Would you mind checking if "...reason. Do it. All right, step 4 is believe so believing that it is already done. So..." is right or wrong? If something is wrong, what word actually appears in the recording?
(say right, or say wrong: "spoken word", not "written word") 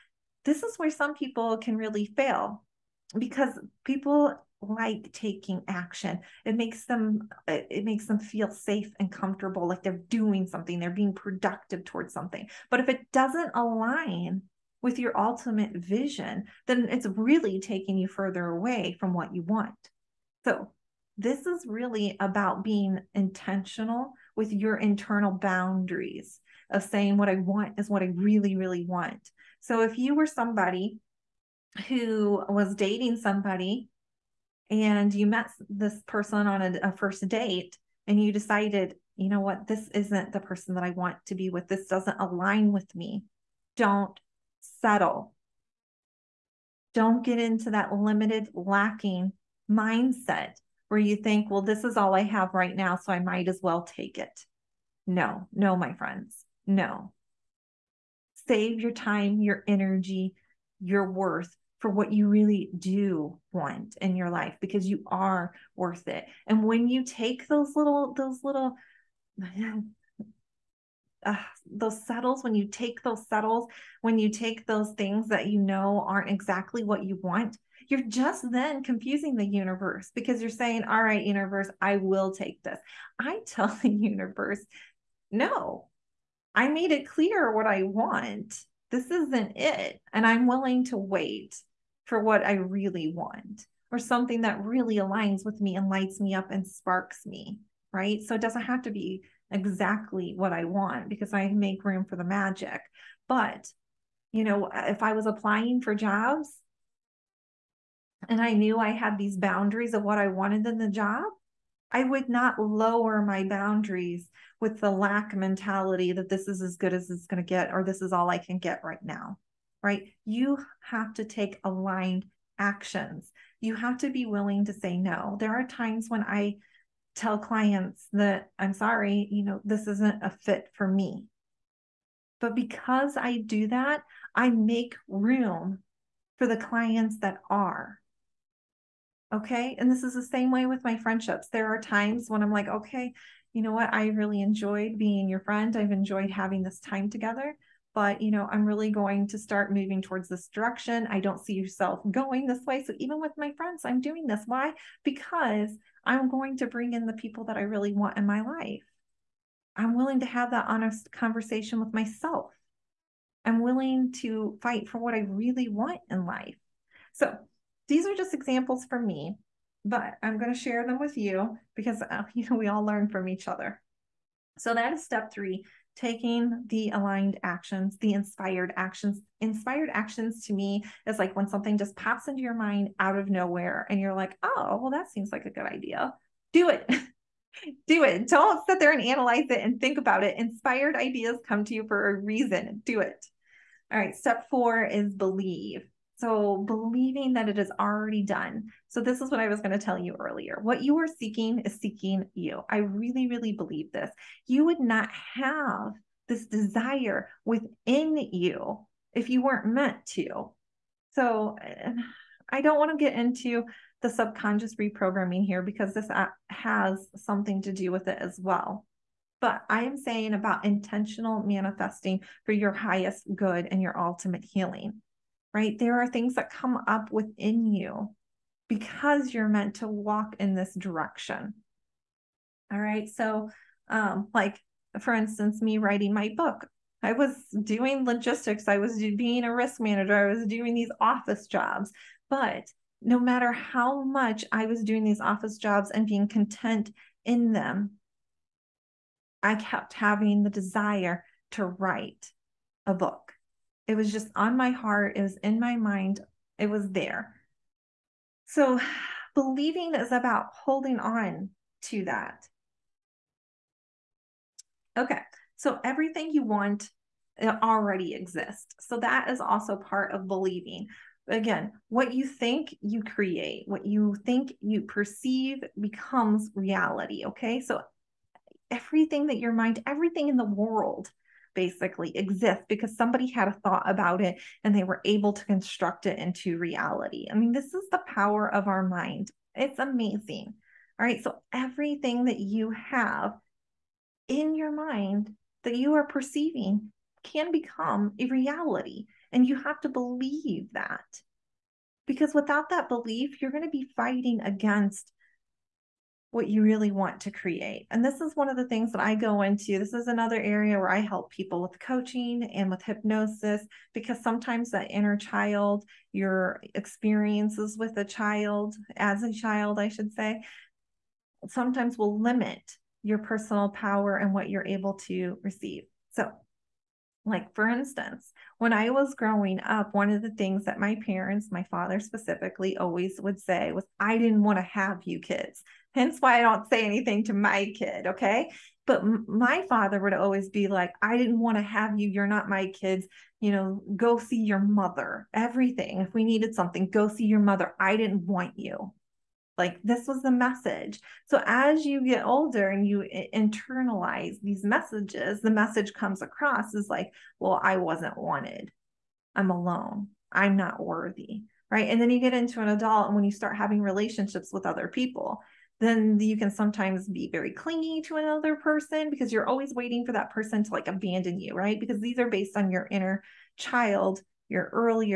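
right.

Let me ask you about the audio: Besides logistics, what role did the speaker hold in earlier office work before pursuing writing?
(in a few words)
Risk manager.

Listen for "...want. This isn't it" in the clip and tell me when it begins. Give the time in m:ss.
1:27.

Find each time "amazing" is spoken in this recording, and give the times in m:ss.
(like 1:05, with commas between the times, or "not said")
4:49.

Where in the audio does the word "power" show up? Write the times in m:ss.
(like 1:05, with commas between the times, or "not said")
4:48, 5:23.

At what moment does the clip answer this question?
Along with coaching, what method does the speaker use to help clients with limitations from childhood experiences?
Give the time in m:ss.
5:12.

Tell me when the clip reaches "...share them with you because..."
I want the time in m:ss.
2:50.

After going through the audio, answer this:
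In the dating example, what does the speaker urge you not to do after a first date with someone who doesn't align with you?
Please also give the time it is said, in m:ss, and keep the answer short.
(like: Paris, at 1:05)
Don't settle, at 0:43.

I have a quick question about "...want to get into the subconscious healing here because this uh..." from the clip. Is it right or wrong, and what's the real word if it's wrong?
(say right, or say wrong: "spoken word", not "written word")
wrong: "reprogramming", not "healing".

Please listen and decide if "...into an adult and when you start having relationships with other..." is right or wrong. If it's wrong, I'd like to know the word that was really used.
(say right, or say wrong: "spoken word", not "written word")
right.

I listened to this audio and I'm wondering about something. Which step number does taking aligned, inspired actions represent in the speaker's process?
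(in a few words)
Step 3.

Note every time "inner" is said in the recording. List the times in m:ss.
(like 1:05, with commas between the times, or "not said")
5:14, 6:12.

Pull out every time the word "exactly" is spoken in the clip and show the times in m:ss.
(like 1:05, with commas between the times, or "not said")
1:16, 1:39.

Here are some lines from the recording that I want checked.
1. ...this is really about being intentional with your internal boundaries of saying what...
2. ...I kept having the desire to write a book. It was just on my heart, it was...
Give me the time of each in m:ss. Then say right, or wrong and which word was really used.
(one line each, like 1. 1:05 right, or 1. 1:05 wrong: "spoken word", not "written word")
1. 0:21 right
2. 4:09 right.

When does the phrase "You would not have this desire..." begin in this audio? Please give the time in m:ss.
3:24.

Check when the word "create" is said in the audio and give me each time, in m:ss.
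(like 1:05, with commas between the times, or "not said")
4:33, 5:07.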